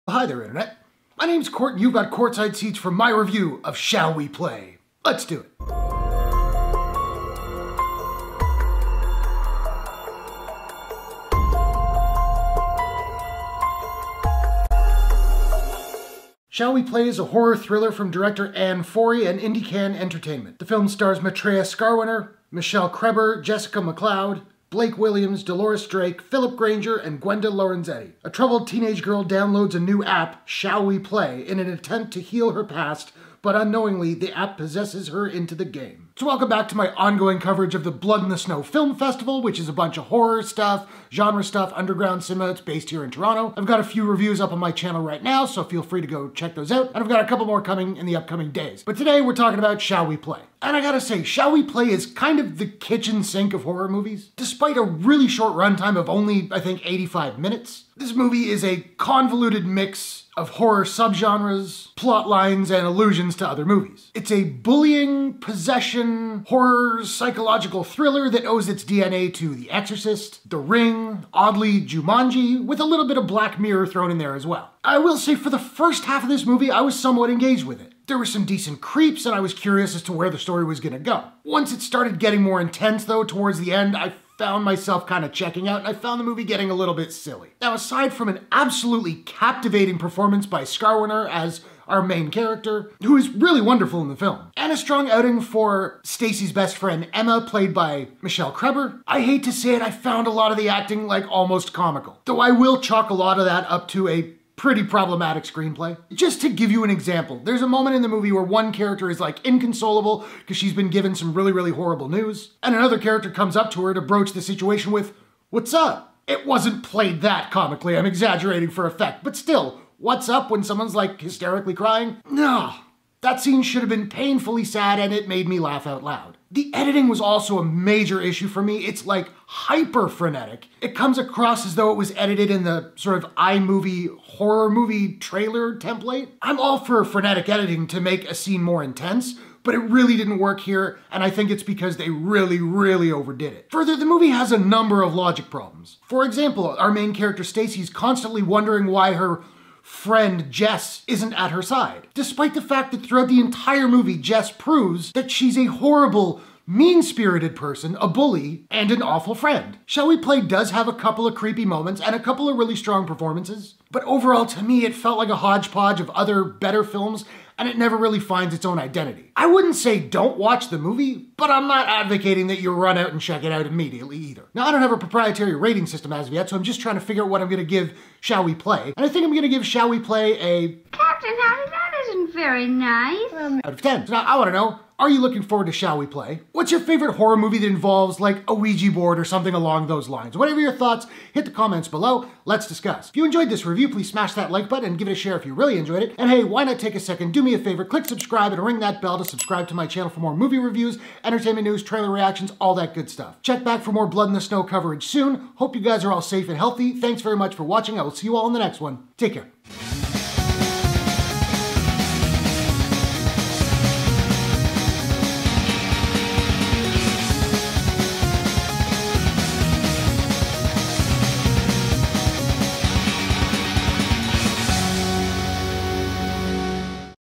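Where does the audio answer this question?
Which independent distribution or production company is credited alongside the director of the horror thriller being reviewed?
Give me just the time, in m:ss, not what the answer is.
0:19.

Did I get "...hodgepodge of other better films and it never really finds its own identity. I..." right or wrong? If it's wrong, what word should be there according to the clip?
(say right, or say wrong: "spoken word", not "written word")
right.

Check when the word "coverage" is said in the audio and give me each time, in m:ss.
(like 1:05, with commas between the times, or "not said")
0:37, 3:24.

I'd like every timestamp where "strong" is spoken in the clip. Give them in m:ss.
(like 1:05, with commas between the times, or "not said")
1:34, 2:42.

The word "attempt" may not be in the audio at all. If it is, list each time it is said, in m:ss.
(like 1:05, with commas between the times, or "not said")
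0:31.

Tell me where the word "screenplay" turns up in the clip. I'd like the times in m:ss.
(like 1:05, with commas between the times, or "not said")
1:45.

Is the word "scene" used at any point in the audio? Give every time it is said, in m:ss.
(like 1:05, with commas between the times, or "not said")
2:03, 2:18.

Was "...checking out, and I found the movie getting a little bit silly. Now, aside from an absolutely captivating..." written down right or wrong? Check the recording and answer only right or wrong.
right.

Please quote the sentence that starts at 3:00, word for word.
Captain, how that isn't very nice.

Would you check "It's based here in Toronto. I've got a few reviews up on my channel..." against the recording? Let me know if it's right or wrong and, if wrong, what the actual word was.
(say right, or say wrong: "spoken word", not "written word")
right.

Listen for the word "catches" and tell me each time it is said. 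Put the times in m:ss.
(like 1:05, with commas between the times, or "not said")
not said.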